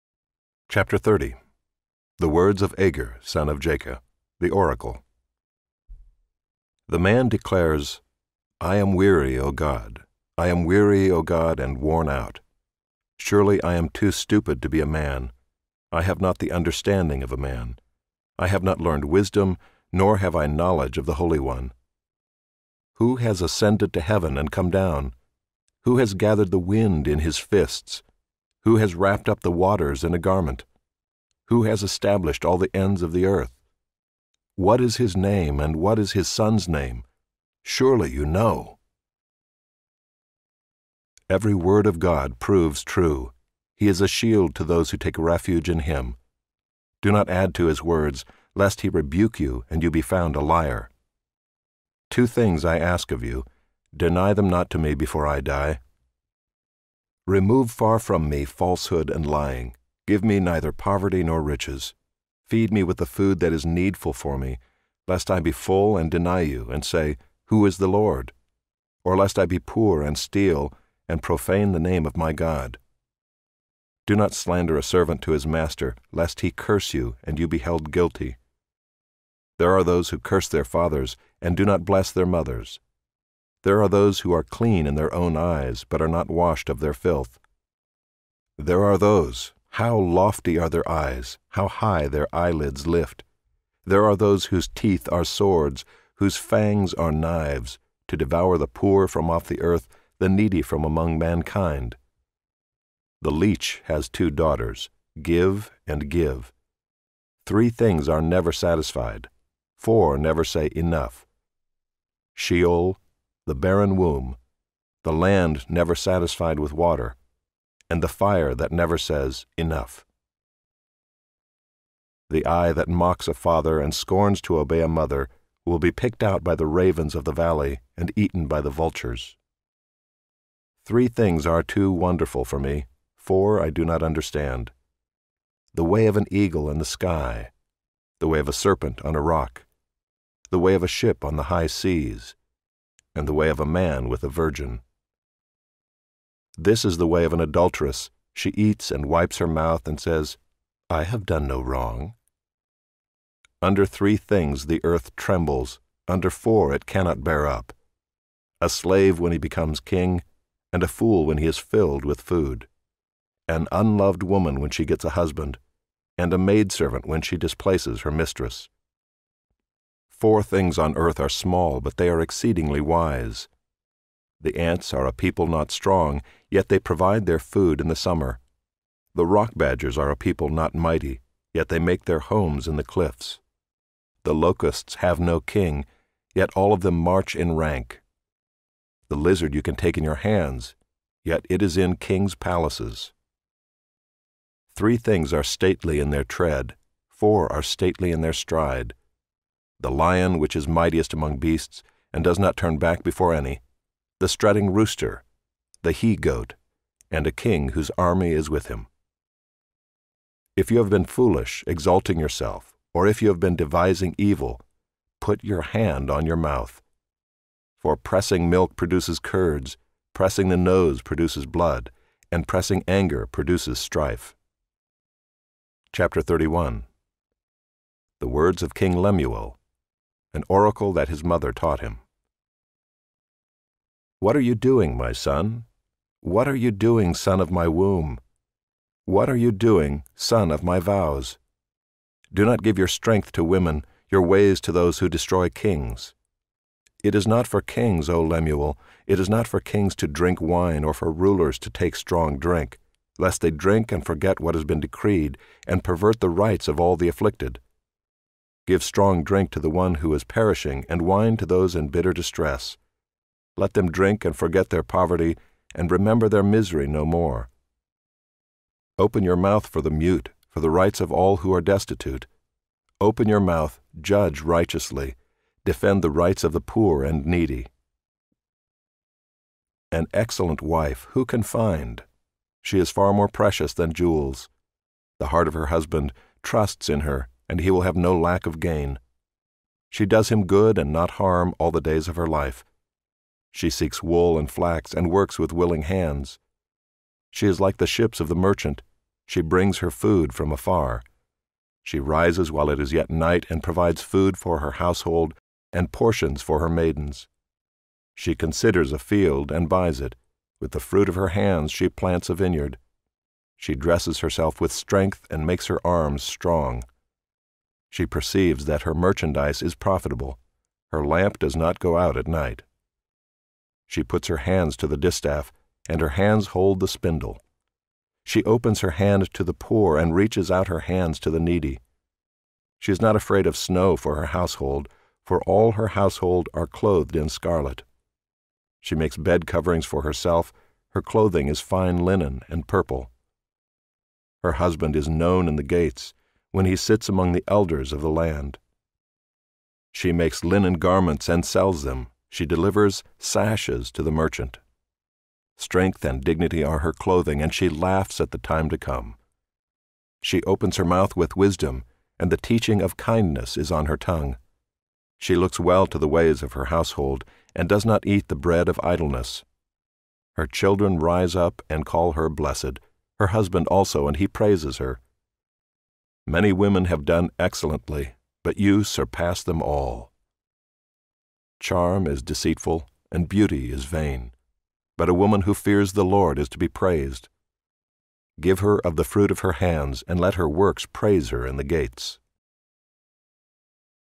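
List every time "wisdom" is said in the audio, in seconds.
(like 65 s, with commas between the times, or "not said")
19 s, 361 s.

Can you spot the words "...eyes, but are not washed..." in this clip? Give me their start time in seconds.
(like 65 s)
85 s.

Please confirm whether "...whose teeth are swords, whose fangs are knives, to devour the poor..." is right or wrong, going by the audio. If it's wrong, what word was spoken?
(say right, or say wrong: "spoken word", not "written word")
right.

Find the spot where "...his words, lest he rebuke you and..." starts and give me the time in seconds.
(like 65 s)
47 s.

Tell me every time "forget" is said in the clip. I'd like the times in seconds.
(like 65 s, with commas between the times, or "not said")
254 s, 264 s.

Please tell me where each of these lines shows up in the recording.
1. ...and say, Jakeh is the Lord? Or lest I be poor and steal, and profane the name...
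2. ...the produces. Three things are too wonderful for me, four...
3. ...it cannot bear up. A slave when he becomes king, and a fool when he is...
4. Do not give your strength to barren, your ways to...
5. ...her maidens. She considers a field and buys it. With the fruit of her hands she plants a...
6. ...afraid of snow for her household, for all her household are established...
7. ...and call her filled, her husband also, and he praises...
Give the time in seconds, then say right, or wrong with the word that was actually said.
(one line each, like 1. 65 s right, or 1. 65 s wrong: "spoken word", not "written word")
1. 66 s wrong: "Who", not "Jakeh"
2. 128 s wrong: "vultures", not "produces"
3. 156 s right
4. 242 s wrong: "women", not "barren"
5. 306 s right
6. 333 s wrong: "clothed", not "established"
7. 371 s wrong: "blessed", not "filled".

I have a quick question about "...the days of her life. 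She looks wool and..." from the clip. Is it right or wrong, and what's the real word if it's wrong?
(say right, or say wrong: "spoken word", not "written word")
wrong: "seeks", not "looks".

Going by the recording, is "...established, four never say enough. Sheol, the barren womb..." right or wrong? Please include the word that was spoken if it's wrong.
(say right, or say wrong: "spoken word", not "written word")
wrong: "satisfied", not "established".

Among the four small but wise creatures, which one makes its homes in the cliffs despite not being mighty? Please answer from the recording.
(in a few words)
Rock badgers.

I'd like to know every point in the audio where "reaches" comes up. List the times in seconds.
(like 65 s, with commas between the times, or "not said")
330 s.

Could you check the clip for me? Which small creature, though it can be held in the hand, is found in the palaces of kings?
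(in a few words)
The lizard.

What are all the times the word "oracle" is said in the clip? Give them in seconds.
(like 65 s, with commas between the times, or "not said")
4 s, 230 s.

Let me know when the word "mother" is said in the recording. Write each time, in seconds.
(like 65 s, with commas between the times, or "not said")
82 s, 124 s, 231 s.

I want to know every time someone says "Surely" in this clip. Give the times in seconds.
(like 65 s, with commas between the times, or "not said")
13 s, 37 s.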